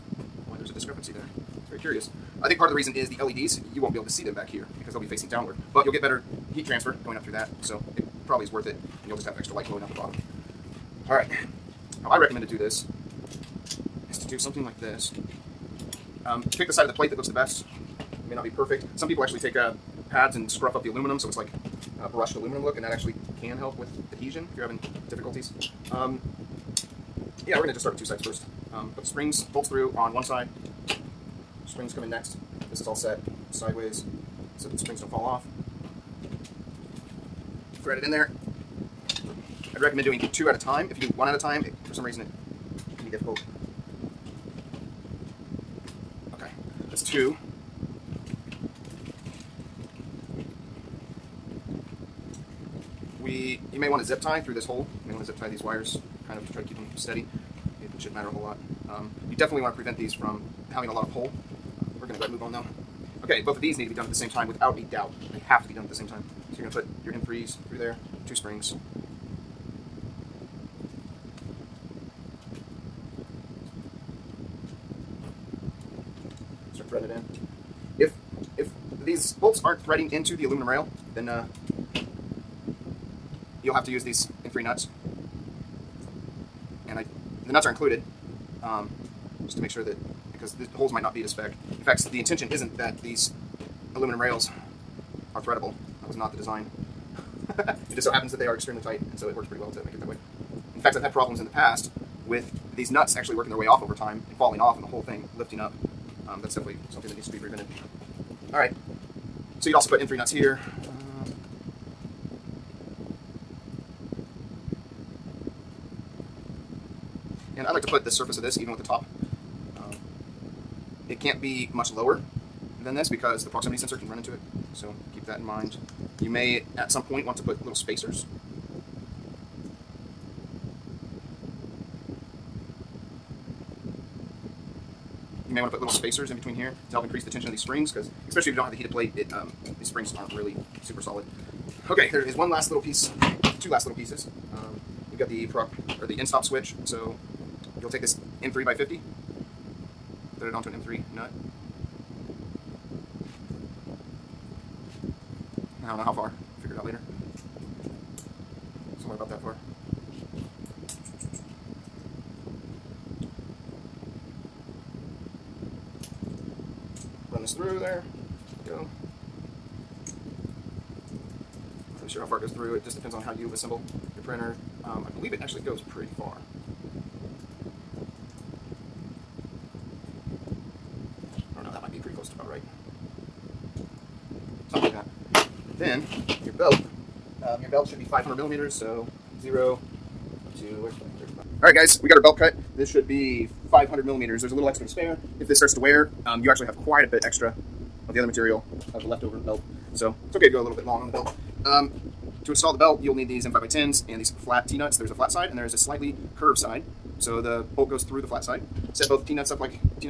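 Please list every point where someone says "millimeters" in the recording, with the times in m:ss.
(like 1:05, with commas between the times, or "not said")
3:08, 3:14.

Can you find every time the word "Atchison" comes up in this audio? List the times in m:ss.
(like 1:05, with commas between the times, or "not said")
not said.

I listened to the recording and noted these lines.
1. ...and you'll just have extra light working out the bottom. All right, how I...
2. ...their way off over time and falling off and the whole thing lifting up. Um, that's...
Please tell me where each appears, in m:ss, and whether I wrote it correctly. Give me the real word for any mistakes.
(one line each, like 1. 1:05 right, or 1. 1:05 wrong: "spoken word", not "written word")
1. 0:09 wrong: "glowing", not "working"
2. 1:43 right.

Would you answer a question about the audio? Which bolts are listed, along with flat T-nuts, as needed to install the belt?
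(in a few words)
M5 by 10.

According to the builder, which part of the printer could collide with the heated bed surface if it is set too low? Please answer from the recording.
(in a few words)
proximity sensor.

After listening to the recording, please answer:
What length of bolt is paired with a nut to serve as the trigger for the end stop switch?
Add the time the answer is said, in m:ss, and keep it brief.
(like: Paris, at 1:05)
M3 by 50, at 2:28.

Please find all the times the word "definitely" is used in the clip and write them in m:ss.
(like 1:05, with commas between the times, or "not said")
0:59, 1:46.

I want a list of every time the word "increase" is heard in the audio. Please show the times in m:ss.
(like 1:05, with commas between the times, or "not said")
2:17.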